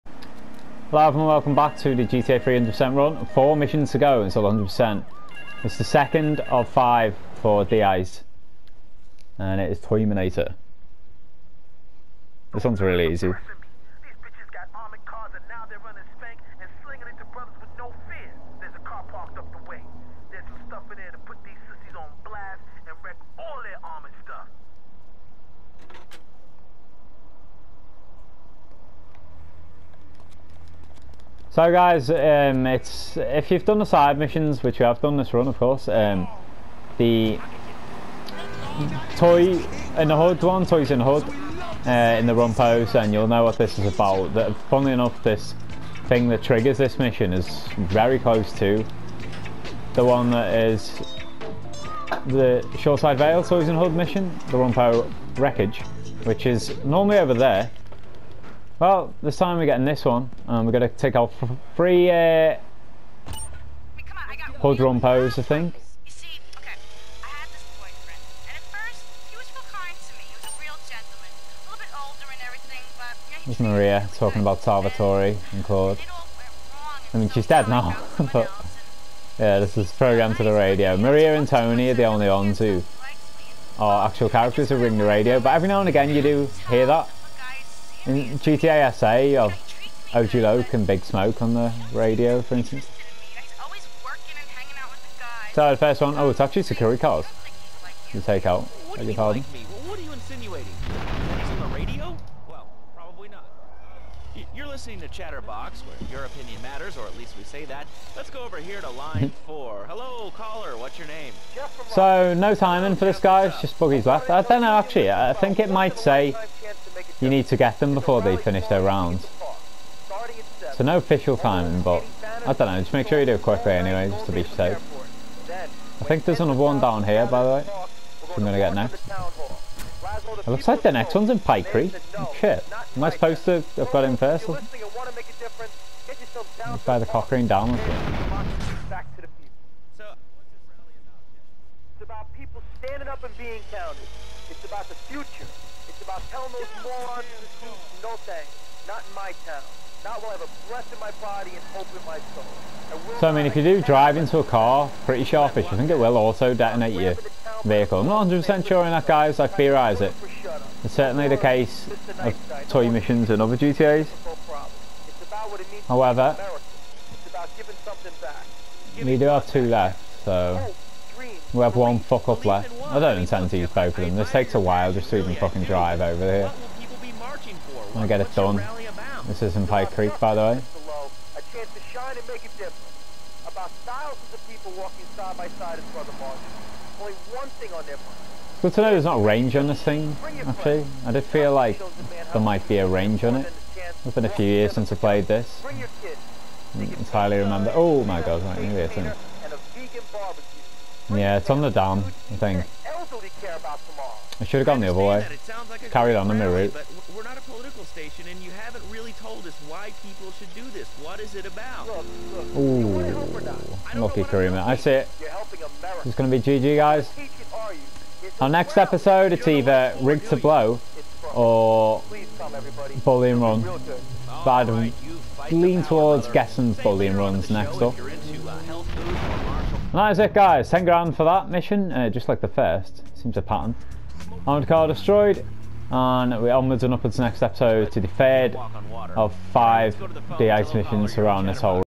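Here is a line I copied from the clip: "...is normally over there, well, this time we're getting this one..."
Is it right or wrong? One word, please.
right.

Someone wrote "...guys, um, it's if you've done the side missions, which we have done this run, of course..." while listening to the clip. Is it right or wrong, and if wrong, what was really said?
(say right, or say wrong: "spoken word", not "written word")
right.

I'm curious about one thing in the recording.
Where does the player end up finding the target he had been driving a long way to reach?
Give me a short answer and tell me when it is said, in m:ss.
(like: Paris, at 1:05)
the dam, at 3:21.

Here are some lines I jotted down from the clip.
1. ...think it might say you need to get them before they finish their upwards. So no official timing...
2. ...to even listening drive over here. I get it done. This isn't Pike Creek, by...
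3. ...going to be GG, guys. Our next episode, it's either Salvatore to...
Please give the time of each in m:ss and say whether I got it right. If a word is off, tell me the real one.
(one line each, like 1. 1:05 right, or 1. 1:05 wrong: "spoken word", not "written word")
1. 1:55 wrong: "rounds", not "upwards"
2. 2:55 wrong: "fucking", not "listening"
3. 3:36 wrong: "Rigged", not "Salvatore".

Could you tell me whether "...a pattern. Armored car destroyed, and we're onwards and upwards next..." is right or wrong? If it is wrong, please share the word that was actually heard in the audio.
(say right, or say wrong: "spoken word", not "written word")
right.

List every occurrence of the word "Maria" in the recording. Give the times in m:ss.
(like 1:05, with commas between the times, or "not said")
1:13, 1:20.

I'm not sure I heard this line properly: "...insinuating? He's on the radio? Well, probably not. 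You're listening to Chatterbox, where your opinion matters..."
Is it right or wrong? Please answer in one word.
right.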